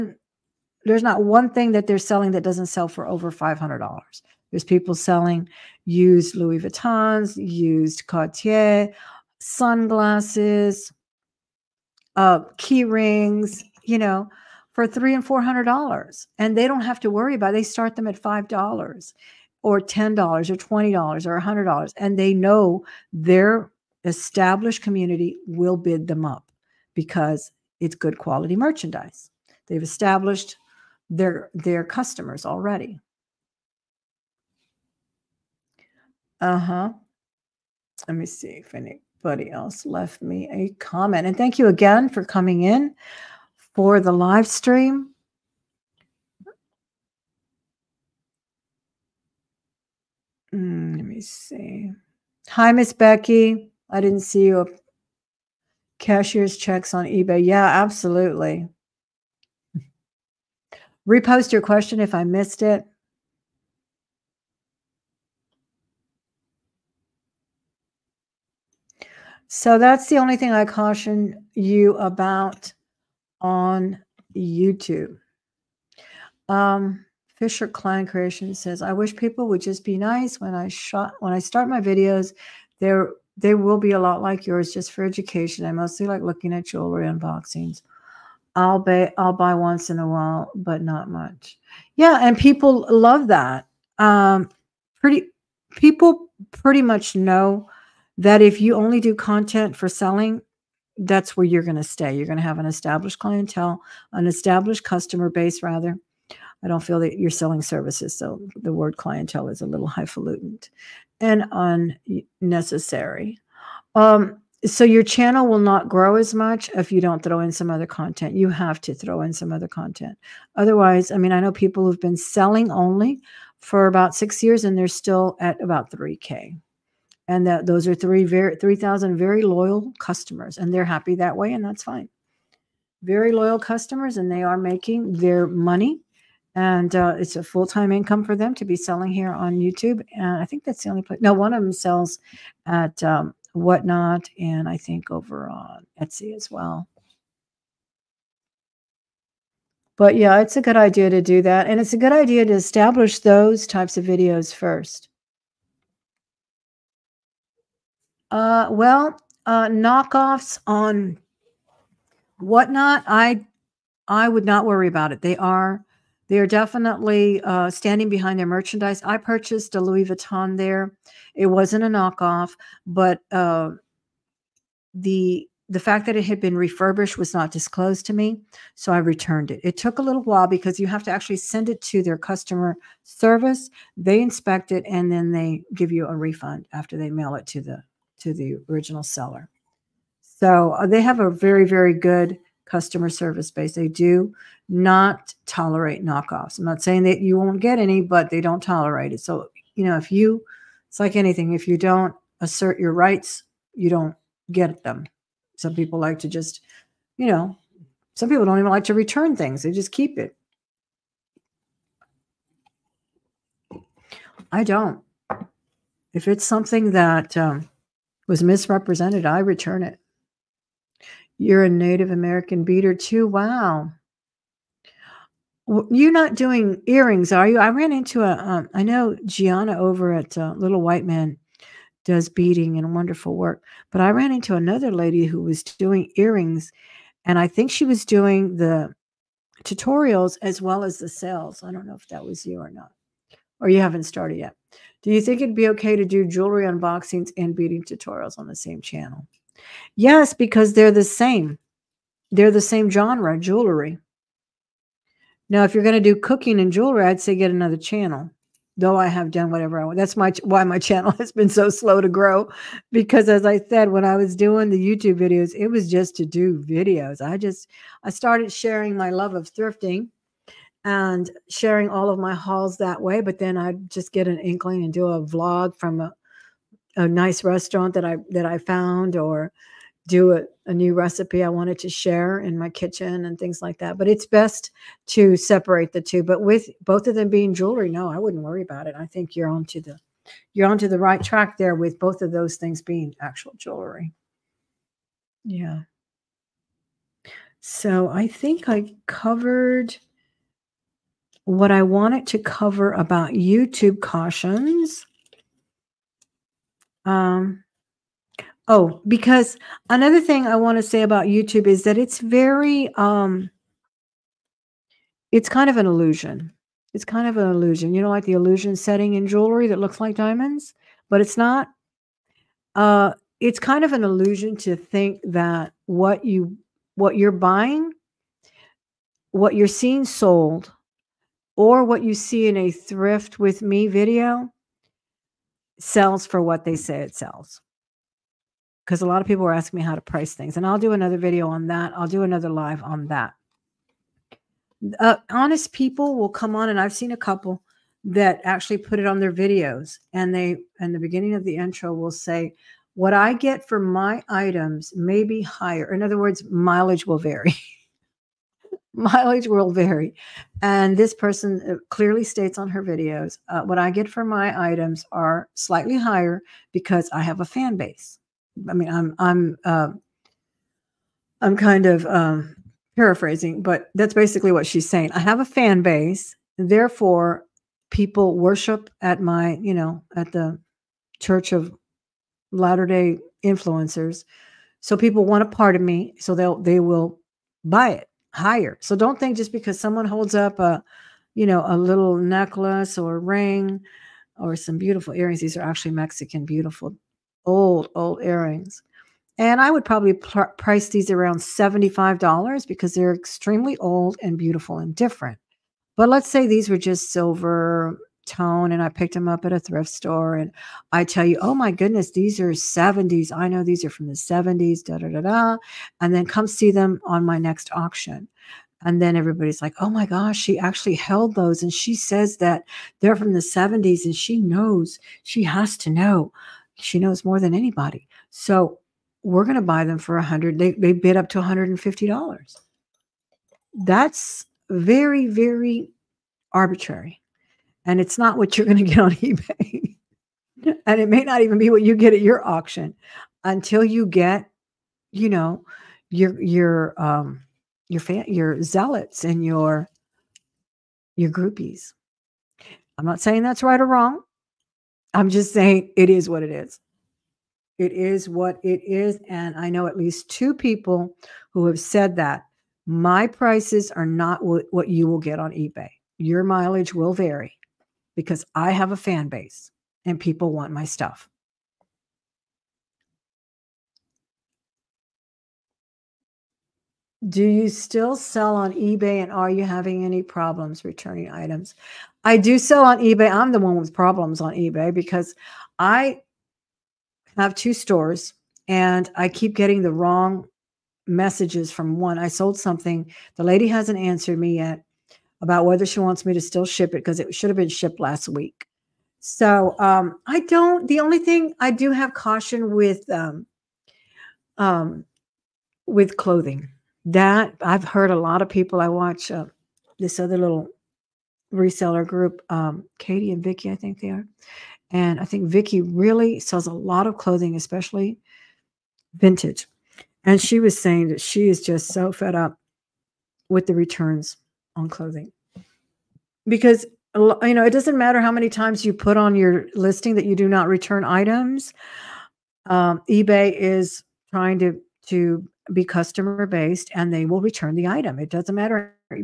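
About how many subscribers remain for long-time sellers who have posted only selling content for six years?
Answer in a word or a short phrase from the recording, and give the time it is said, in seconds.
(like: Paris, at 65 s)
3K, at 125 s.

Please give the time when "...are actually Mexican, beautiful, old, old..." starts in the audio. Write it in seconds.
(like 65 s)
395 s.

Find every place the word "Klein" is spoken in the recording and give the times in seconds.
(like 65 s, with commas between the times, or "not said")
77 s.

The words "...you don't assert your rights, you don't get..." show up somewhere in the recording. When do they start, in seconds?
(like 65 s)
201 s.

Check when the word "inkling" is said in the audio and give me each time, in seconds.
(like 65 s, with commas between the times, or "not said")
274 s.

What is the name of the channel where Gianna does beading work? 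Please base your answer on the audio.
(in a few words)
Little White Man.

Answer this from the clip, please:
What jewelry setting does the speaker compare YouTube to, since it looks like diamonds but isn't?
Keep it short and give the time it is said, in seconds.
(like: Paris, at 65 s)
illusion setting, at 318 s.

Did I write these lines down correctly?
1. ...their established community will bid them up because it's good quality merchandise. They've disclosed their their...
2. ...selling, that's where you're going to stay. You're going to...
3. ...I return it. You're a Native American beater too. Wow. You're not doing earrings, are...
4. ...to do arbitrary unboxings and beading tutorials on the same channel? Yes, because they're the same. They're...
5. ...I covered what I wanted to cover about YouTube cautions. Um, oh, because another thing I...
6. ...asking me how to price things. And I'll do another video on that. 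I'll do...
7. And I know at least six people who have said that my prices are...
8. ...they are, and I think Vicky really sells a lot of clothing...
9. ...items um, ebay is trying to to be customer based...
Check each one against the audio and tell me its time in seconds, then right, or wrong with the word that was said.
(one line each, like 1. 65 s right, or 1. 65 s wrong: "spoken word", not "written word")
1. 23 s wrong: "established", not "disclosed"
2. 99 s right
3. 219 s right
4. 245 s wrong: "jewelry", not "arbitrary"
5. 298 s right
6. 339 s right
7. 459 s wrong: "two", not "six"
8. 513 s right
9. 531 s right.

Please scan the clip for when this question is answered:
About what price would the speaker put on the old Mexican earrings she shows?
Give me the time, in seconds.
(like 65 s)
401 s.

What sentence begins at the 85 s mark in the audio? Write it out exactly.
I mostly like looking at jewelry unboxings.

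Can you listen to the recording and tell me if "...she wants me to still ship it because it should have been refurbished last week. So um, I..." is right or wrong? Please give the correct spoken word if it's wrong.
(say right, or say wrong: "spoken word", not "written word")
wrong: "shipped", not "refurbished".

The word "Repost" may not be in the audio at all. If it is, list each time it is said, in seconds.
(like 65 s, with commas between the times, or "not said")
61 s.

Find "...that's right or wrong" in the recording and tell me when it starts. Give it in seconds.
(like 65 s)
453 s.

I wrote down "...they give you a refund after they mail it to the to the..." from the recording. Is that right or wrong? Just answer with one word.
right.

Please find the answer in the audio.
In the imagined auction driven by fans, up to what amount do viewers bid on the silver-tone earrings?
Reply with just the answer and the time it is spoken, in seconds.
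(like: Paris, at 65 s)
$150, at 431 s.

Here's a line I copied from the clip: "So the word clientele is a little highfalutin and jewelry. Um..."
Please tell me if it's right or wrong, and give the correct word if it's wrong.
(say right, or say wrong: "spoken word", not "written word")
wrong: "unnecessary", not "jewelry".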